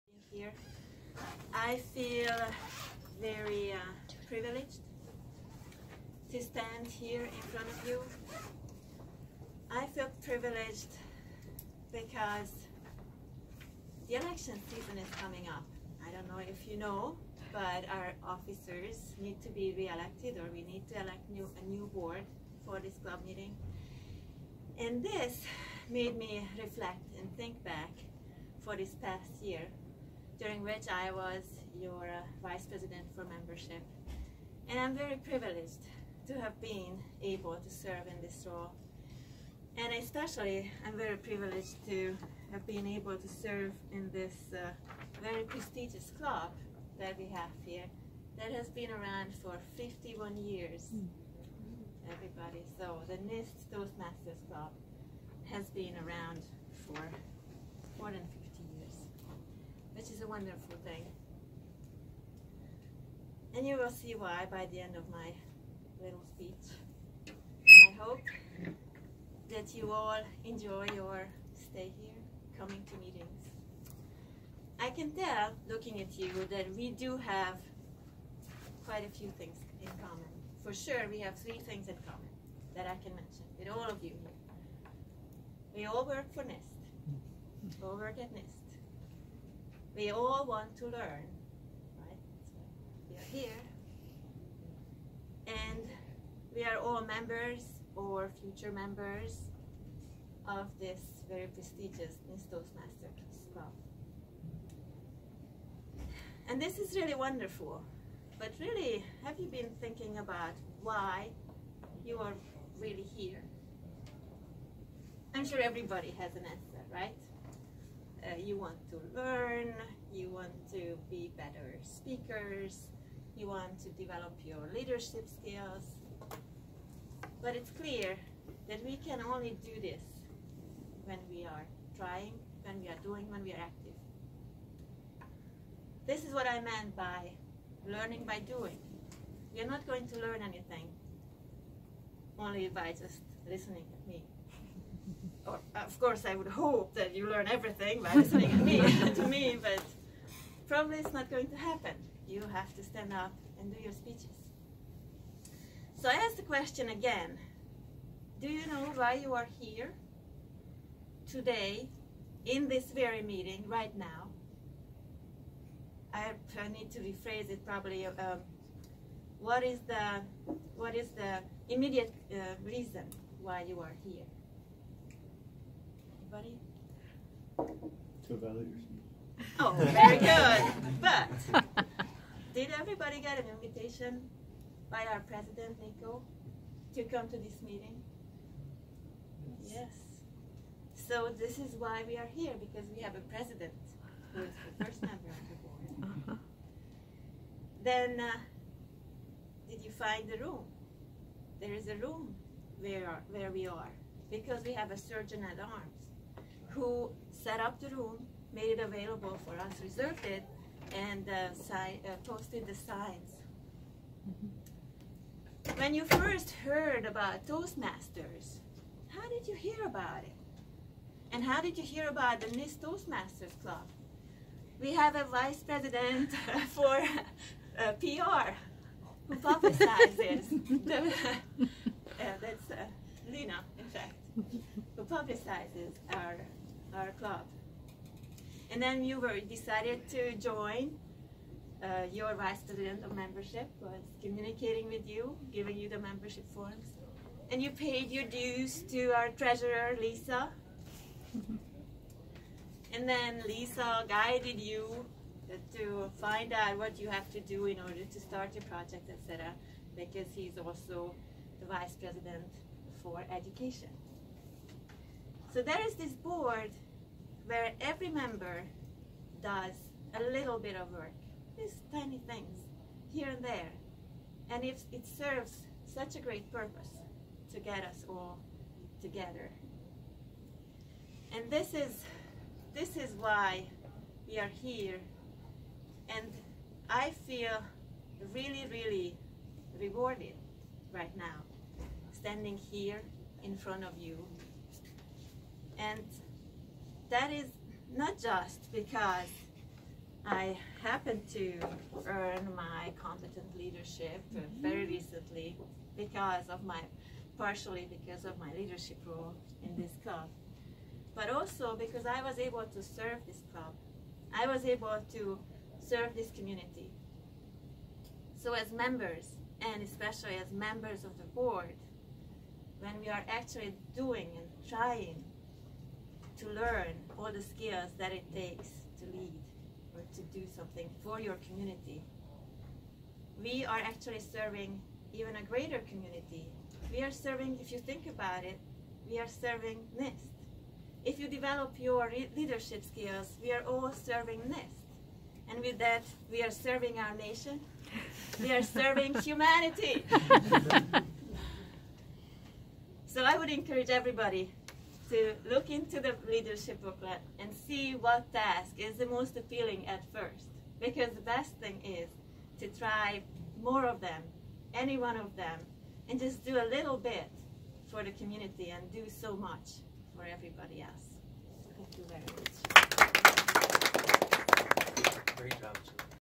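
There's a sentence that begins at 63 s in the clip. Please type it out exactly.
And you will see why by the end of my little speech.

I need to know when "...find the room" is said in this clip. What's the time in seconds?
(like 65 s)
200 s.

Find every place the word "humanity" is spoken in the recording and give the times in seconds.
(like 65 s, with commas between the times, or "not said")
349 s.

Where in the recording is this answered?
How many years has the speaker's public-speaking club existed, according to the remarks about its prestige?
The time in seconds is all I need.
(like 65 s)
49 s.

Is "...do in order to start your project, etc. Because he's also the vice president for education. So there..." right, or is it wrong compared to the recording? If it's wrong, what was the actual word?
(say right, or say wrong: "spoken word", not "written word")
right.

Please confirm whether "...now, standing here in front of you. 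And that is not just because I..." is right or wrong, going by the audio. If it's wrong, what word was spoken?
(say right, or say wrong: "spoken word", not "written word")
right.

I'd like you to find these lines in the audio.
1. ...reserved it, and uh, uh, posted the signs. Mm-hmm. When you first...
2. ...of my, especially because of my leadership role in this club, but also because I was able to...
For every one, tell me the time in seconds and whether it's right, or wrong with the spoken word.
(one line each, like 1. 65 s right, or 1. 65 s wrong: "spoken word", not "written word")
1. 209 s right
2. 306 s wrong: "partially", not "especially".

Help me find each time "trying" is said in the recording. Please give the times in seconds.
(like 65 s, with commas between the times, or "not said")
131 s, 324 s.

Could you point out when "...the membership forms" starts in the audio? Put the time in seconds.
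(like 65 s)
245 s.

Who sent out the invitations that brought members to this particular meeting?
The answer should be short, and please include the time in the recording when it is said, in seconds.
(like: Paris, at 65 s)
Nico, at 185 s.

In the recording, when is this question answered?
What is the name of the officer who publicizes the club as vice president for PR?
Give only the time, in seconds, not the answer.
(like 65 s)
233 s.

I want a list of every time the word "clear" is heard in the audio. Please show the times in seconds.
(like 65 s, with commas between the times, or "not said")
127 s.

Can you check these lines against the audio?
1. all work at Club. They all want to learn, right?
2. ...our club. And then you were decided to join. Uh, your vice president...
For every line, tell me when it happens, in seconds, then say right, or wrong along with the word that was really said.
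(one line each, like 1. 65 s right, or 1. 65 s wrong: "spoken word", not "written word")
1. 87 s wrong: "NIST", not "Club"
2. 236 s right.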